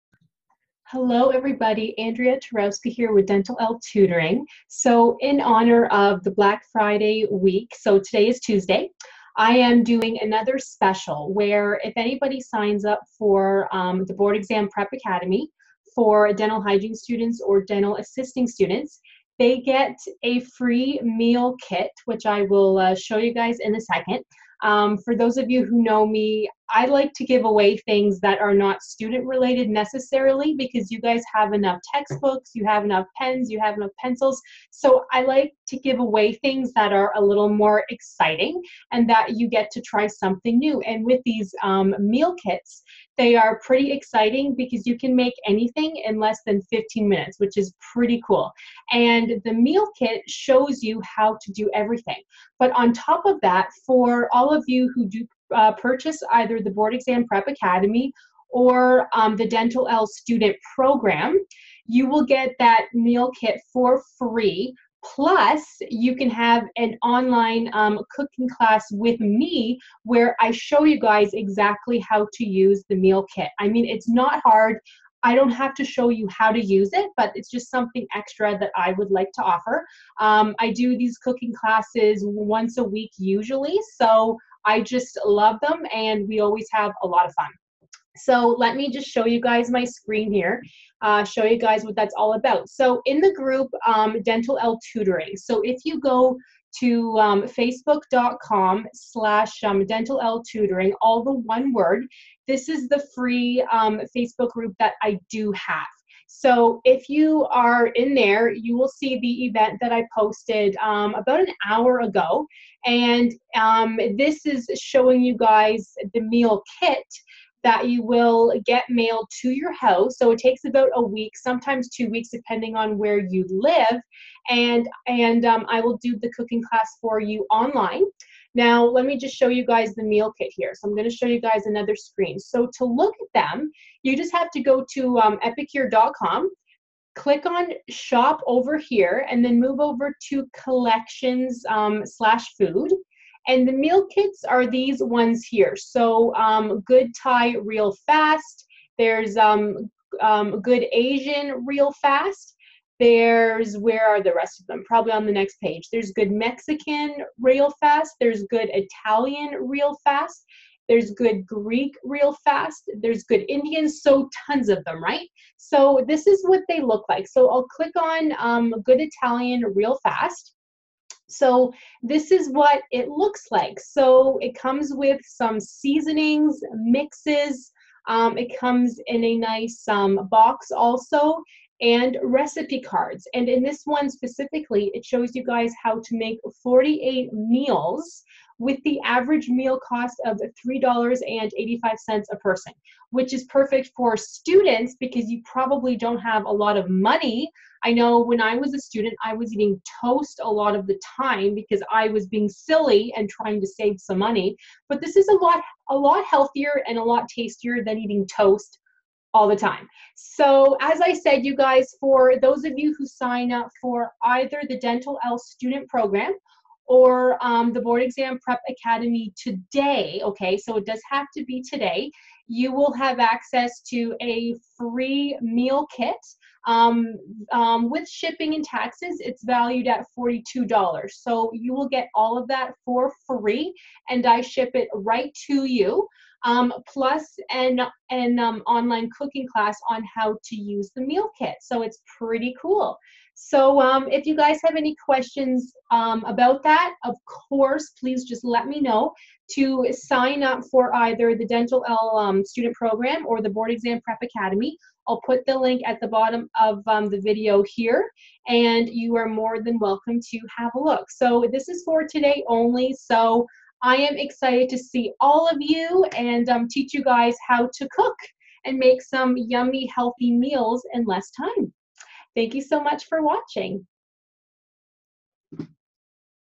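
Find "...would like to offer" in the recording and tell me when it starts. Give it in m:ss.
1:18.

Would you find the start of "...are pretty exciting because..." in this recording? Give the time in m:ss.
0:43.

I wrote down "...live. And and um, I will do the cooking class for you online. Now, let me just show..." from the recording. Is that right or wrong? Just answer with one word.
right.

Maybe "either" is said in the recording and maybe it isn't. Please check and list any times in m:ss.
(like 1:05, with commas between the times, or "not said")
0:56, 3:34, 4:10.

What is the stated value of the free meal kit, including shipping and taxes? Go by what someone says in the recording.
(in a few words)
$42.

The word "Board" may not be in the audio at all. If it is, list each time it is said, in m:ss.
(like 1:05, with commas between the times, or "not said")
0:14, 0:56, 3:37, 4:13.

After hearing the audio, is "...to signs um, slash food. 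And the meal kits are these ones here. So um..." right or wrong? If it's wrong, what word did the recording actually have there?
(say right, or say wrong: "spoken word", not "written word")
wrong: "collections", not "signs".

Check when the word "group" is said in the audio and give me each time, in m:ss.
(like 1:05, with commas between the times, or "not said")
1:33, 1:44.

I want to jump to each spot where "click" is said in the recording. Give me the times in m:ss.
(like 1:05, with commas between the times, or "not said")
2:17, 2:47.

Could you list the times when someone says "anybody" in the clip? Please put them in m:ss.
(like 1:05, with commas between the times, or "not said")
0:11.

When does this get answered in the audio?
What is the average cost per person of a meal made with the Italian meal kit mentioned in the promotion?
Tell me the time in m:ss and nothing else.
3:10.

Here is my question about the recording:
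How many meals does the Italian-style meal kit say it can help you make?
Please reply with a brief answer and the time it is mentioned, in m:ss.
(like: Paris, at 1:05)
48, at 3:06.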